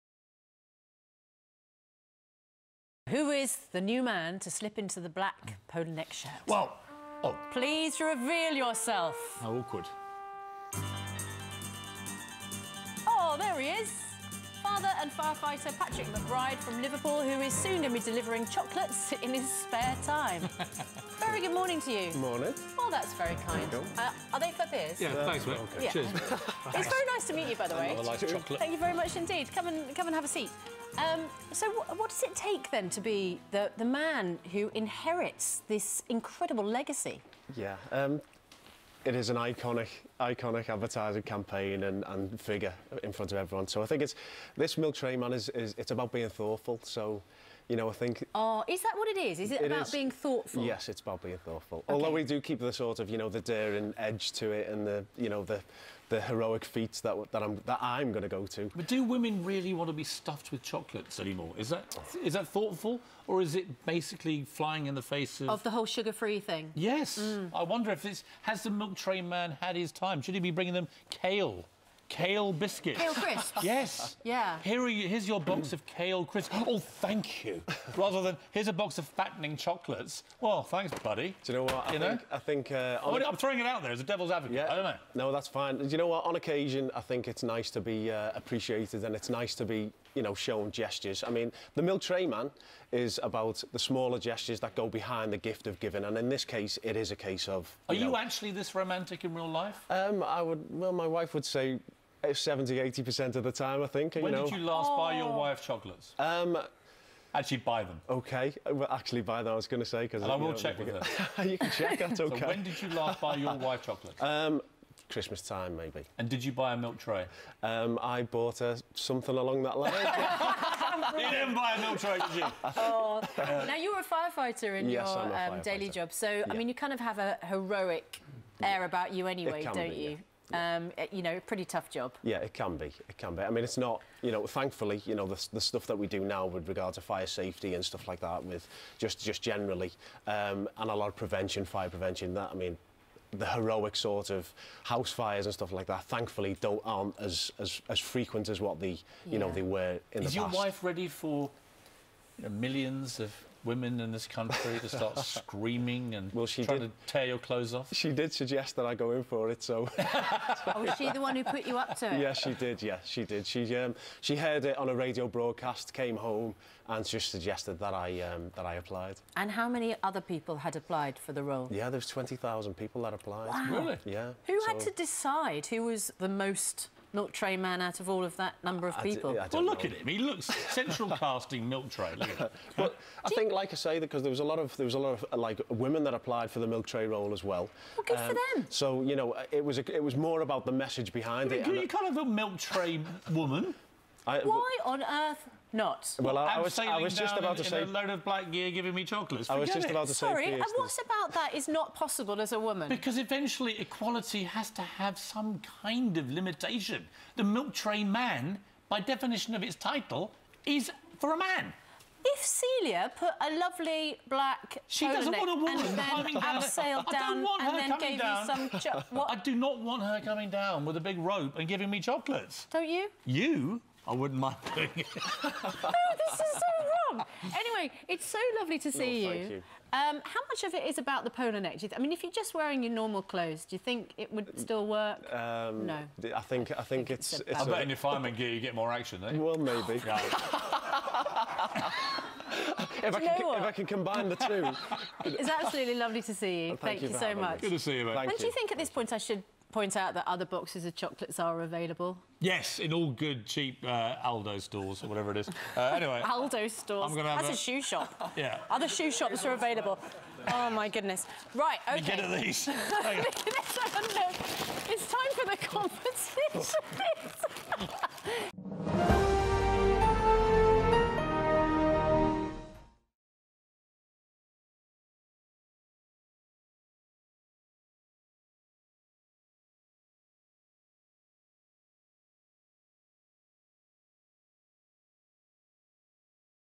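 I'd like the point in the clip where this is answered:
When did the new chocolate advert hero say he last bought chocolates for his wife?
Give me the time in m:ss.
1:55.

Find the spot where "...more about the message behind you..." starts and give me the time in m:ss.
3:10.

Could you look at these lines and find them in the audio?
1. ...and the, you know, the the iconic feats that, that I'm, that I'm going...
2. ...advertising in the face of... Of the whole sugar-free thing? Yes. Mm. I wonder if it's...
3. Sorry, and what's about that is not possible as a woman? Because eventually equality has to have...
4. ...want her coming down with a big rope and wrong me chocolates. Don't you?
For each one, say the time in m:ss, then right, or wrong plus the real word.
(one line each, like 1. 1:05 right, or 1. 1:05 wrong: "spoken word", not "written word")
1. 0:54 wrong: "heroic", not "iconic"
2. 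1:04 wrong: "flying", not "advertising"
3. 3:20 right
4. 3:39 wrong: "giving", not "wrong".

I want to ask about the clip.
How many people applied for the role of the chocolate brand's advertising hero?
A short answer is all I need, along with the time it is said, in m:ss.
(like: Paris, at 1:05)
20,000, at 2:52.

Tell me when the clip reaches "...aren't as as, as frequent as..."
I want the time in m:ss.
2:26.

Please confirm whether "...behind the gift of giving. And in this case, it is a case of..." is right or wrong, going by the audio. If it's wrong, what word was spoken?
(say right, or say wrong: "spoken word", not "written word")
right.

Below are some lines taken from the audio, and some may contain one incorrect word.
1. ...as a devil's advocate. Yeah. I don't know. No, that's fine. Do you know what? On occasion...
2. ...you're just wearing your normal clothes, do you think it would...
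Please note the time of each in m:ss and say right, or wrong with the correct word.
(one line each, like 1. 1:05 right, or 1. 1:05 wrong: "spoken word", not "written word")
1. 1:23 right
2. 3:52 right.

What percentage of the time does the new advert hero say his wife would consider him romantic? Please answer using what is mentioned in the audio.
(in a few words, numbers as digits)
70-80%.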